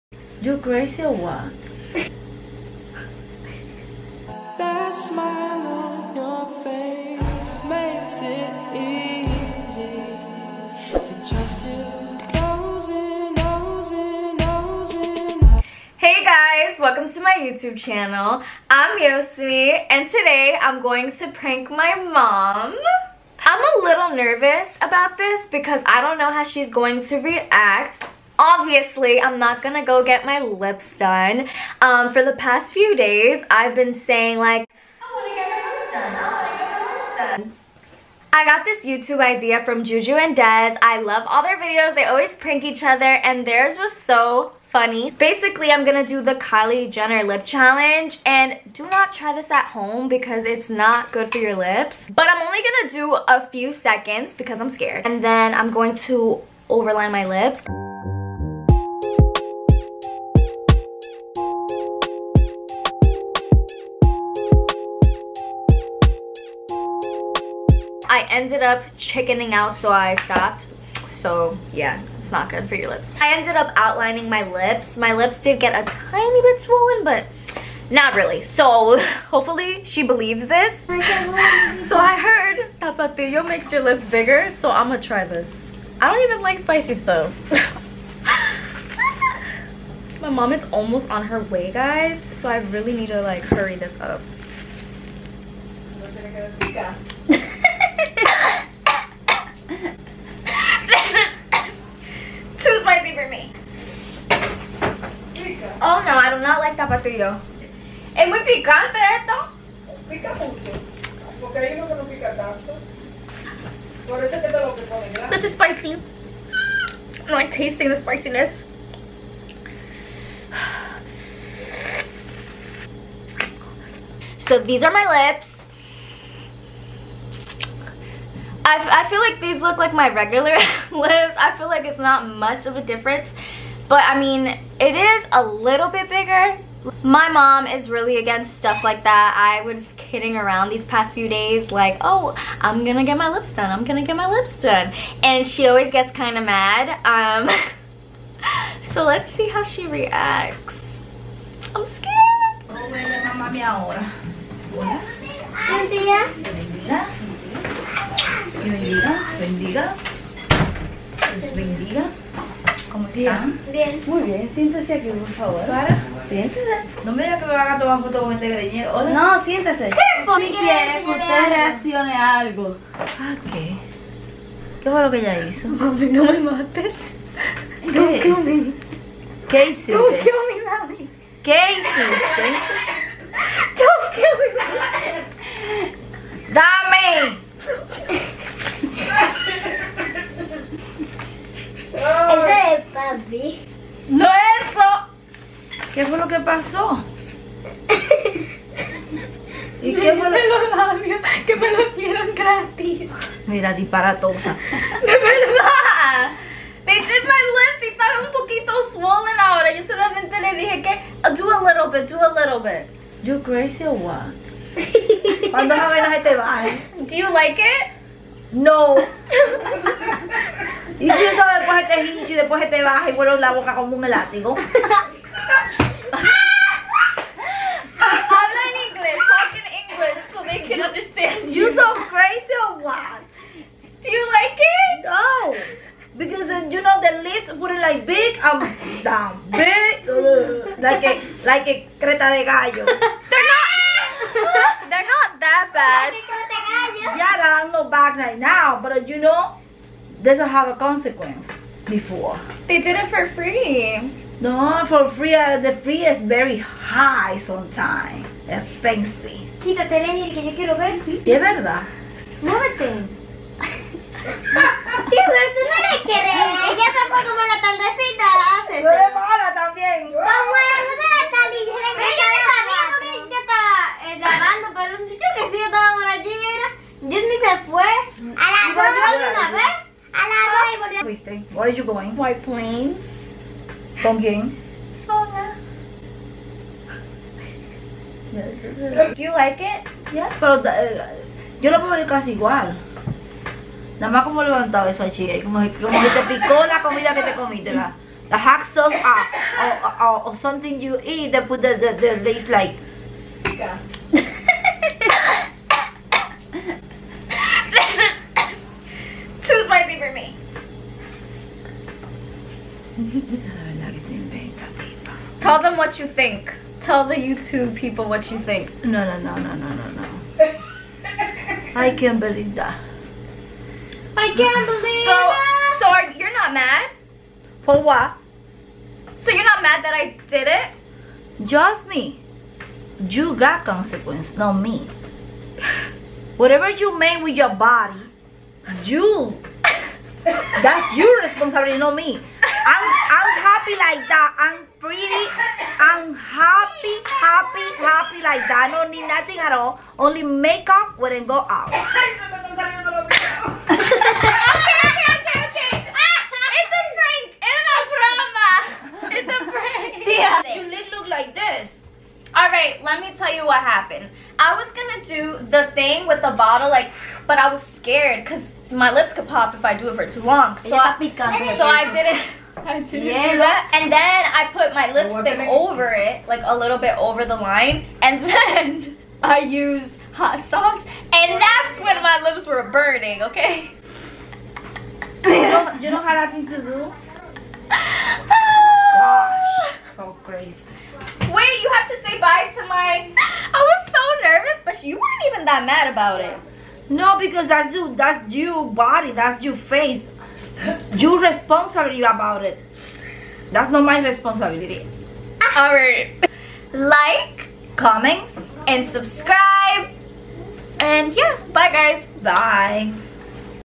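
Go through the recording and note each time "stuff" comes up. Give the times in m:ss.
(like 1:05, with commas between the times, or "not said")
1:26, 2:18.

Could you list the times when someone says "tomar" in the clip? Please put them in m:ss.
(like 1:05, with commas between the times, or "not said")
2:47.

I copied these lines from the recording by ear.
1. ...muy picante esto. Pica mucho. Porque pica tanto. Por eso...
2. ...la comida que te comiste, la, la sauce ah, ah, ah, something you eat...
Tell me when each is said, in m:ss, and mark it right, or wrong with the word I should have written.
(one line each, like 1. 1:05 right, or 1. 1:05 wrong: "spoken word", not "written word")
1. 1:48 right
2. 4:56 right.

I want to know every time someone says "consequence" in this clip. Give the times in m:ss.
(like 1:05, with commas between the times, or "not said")
4:10, 5:33.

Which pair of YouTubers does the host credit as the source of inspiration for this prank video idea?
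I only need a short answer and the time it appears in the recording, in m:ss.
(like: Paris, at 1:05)
Juju and Dez, at 0:39.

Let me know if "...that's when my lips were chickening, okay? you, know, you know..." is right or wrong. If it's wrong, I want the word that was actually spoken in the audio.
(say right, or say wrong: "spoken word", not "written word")
wrong: "burning", not "chickening".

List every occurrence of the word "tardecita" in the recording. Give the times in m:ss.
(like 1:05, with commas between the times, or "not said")
4:27.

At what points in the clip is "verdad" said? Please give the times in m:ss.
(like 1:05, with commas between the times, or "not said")
3:25, 4:21.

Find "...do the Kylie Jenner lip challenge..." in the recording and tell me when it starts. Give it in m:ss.
0:46.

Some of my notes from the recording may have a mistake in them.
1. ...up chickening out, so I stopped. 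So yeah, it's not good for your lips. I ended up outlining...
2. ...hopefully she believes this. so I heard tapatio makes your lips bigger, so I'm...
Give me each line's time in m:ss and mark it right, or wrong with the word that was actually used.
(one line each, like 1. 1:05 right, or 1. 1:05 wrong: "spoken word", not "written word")
1. 1:08 right
2. 1:19 right.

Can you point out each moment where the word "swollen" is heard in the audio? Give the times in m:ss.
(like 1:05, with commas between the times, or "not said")
1:16, 3:28.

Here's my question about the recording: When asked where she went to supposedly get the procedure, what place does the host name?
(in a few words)
White Plains.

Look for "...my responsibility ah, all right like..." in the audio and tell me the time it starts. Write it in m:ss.
6:43.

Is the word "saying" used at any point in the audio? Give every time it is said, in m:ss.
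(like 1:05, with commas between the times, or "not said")
0:33.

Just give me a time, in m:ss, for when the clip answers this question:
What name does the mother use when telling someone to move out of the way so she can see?
4:20.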